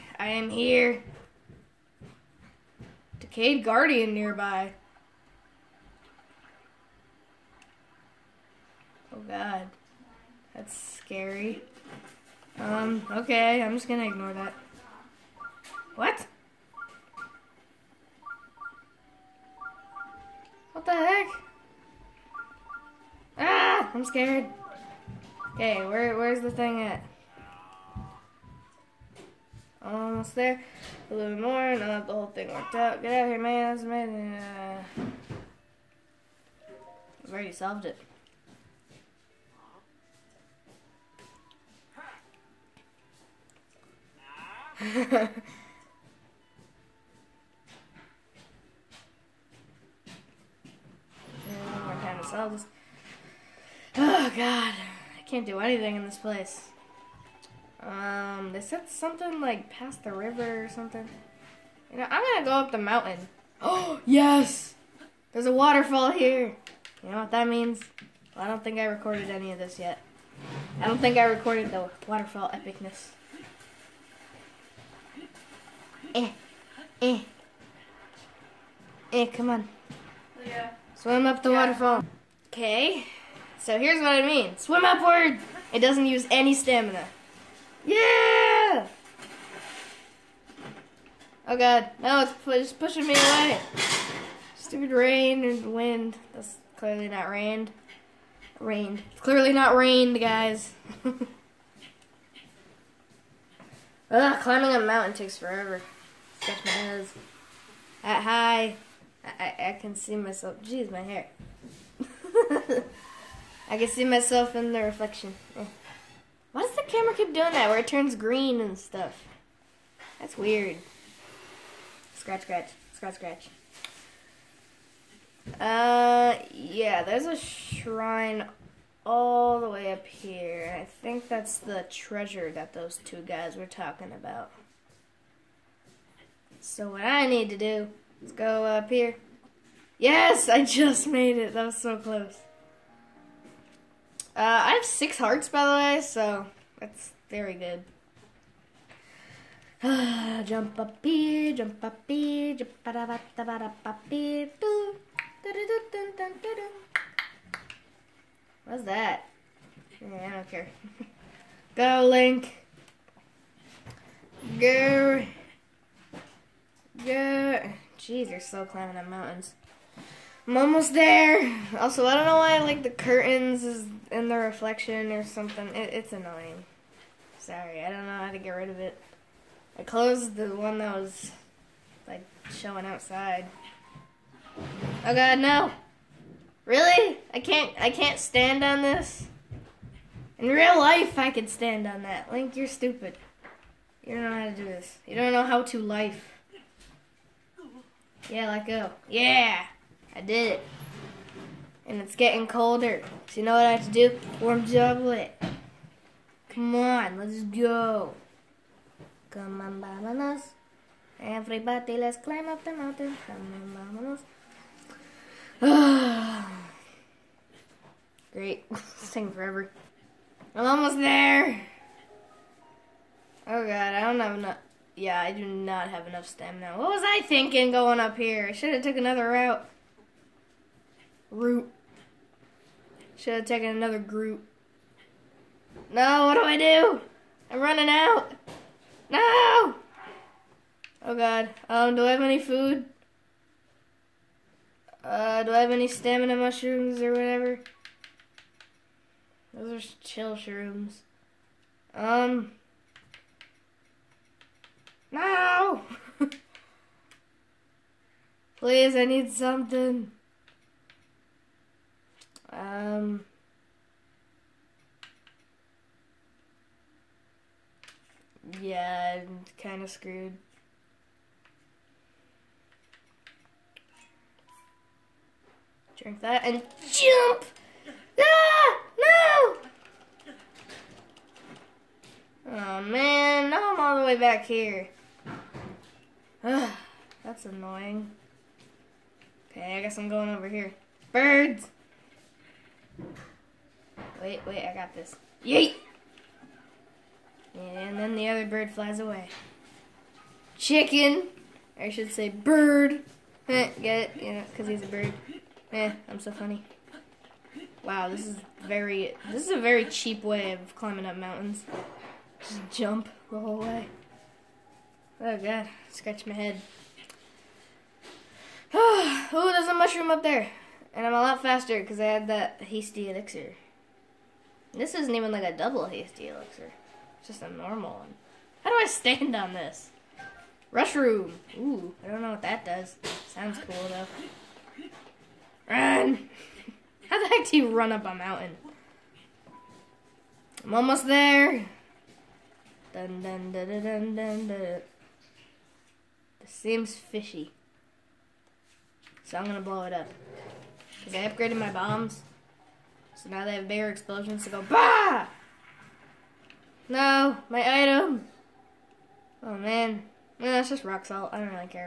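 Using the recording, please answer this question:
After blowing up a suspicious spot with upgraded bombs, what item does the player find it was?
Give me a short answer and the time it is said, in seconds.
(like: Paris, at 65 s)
rock salt, at 360 s.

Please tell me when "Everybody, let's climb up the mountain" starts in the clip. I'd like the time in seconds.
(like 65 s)
211 s.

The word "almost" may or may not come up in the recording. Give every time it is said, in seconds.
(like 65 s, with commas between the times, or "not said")
29 s, 220 s, 340 s.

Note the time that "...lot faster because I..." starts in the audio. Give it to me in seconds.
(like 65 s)
321 s.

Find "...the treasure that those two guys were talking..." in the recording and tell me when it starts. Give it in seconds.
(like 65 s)
131 s.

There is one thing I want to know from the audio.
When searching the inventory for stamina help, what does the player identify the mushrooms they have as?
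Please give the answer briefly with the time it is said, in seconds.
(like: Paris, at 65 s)
chill shrooms, at 250 s.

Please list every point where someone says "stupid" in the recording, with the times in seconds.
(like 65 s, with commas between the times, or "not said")
94 s, 192 s.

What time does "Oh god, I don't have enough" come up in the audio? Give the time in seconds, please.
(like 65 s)
223 s.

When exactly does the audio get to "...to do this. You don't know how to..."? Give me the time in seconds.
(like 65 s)
194 s.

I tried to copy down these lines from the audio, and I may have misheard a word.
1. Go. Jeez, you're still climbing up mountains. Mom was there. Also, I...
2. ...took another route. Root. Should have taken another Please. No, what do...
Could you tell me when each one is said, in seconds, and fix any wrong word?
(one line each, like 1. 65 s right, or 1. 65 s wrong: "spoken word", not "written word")
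1. 167 s right
2. 228 s wrong: "Groot", not "Please".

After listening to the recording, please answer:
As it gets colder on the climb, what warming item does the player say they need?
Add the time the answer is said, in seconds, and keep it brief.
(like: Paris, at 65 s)
Warm chocolate, at 204 s.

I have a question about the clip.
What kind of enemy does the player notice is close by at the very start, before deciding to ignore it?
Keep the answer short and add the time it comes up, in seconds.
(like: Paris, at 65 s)
Decayed Guardian, at 3 s.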